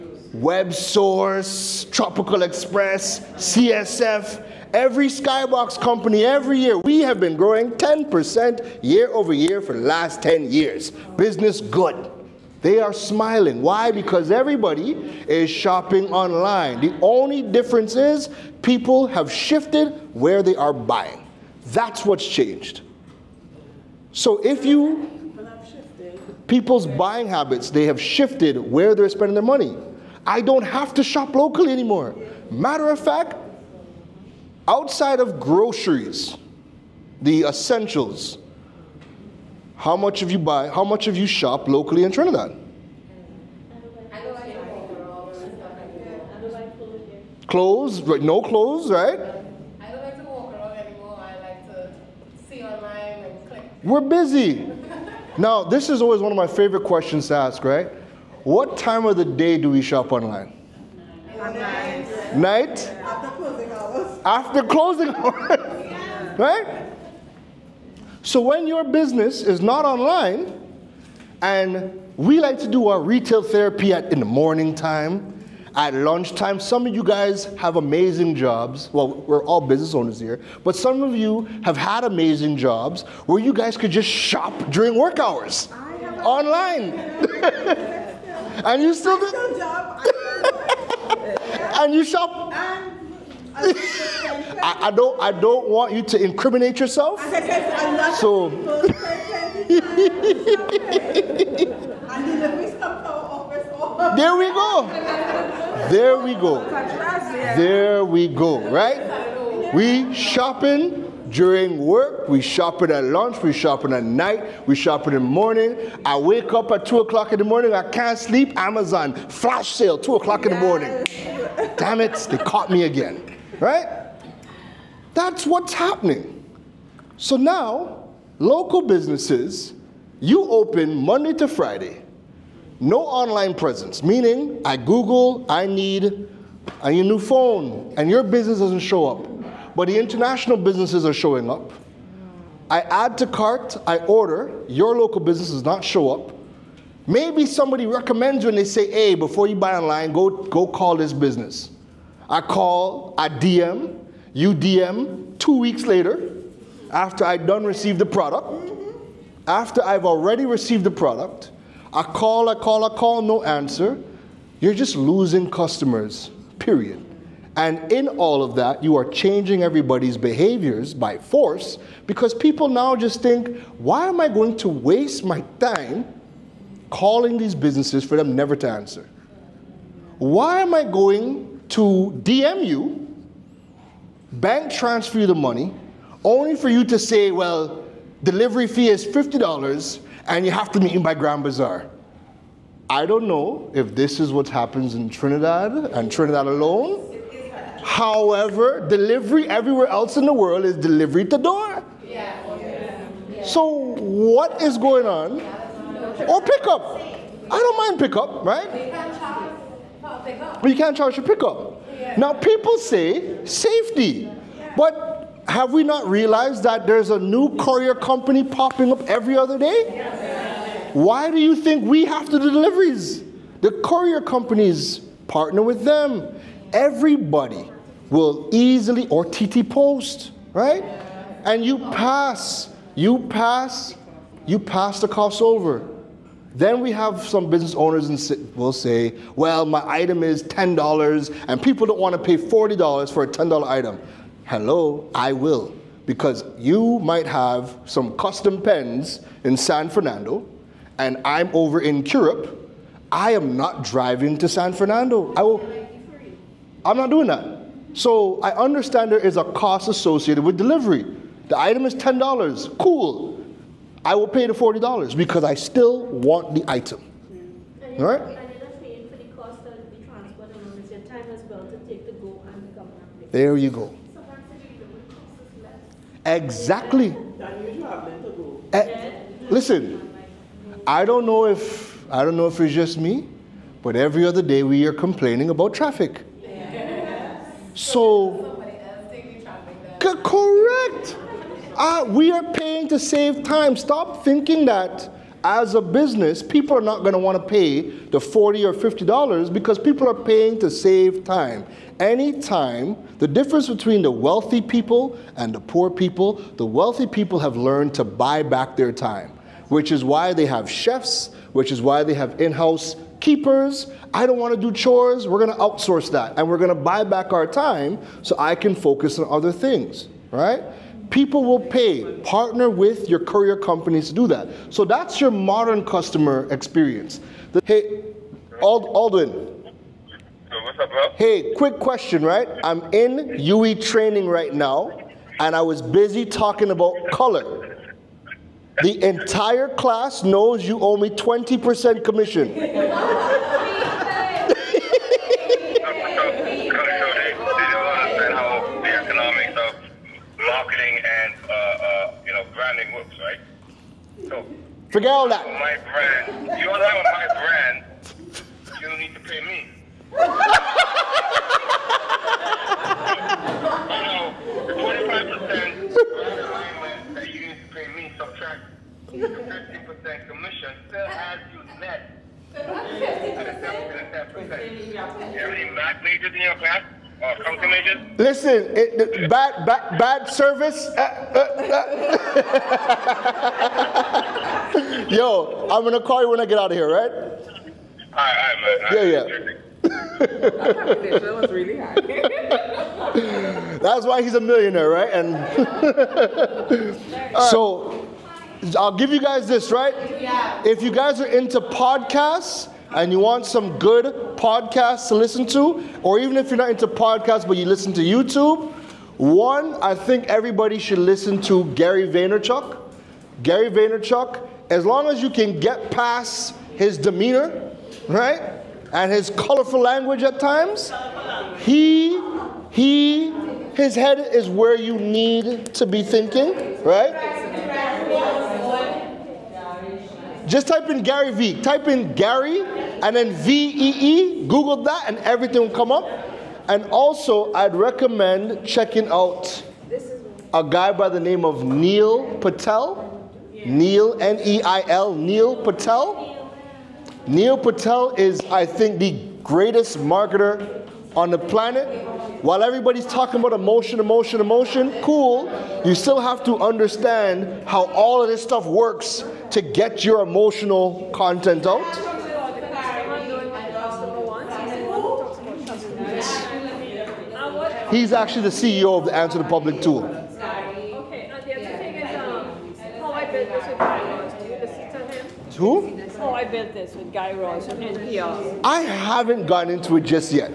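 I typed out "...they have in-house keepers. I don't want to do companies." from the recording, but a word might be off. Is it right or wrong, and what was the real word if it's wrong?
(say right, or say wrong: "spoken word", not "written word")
wrong: "chores", not "companies".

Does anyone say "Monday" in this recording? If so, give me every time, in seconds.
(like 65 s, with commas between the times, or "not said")
130 s.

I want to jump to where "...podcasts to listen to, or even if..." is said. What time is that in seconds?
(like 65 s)
404 s.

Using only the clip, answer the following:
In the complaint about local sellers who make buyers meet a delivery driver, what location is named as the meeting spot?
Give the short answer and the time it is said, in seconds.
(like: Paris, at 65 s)
Grand Bazaar, at 191 s.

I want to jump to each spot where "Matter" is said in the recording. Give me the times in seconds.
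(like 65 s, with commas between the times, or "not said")
32 s.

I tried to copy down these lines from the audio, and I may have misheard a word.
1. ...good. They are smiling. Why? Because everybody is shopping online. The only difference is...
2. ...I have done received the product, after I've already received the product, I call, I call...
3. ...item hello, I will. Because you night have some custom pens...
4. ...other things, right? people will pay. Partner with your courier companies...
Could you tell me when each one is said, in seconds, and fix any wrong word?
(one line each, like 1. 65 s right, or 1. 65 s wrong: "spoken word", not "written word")
1. 11 s right
2. 157 s right
3. 243 s wrong: "might", not "night"
4. 319 s right.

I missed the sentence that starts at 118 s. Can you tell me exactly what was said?
Amazon, flash sale, 2 o'clock in the morning.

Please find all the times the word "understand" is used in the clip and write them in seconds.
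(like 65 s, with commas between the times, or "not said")
258 s, 456 s.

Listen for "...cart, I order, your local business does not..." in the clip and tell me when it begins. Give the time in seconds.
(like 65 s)
143 s.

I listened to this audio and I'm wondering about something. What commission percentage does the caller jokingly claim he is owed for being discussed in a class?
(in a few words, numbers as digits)
20%.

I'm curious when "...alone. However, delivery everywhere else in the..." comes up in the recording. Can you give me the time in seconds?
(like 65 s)
196 s.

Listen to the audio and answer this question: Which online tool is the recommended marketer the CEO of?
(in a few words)
Answer the Public.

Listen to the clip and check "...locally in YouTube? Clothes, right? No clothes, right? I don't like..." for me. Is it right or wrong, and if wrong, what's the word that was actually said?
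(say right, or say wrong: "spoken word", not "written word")
wrong: "Trinidad", not "YouTube".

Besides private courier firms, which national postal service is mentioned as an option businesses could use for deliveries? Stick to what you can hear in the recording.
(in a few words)
TT Post.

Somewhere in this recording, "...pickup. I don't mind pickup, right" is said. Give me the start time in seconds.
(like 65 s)
206 s.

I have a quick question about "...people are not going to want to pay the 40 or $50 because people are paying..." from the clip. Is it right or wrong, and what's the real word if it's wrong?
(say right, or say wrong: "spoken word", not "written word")
right.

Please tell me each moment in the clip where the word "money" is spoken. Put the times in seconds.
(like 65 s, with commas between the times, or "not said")
29 s, 185 s.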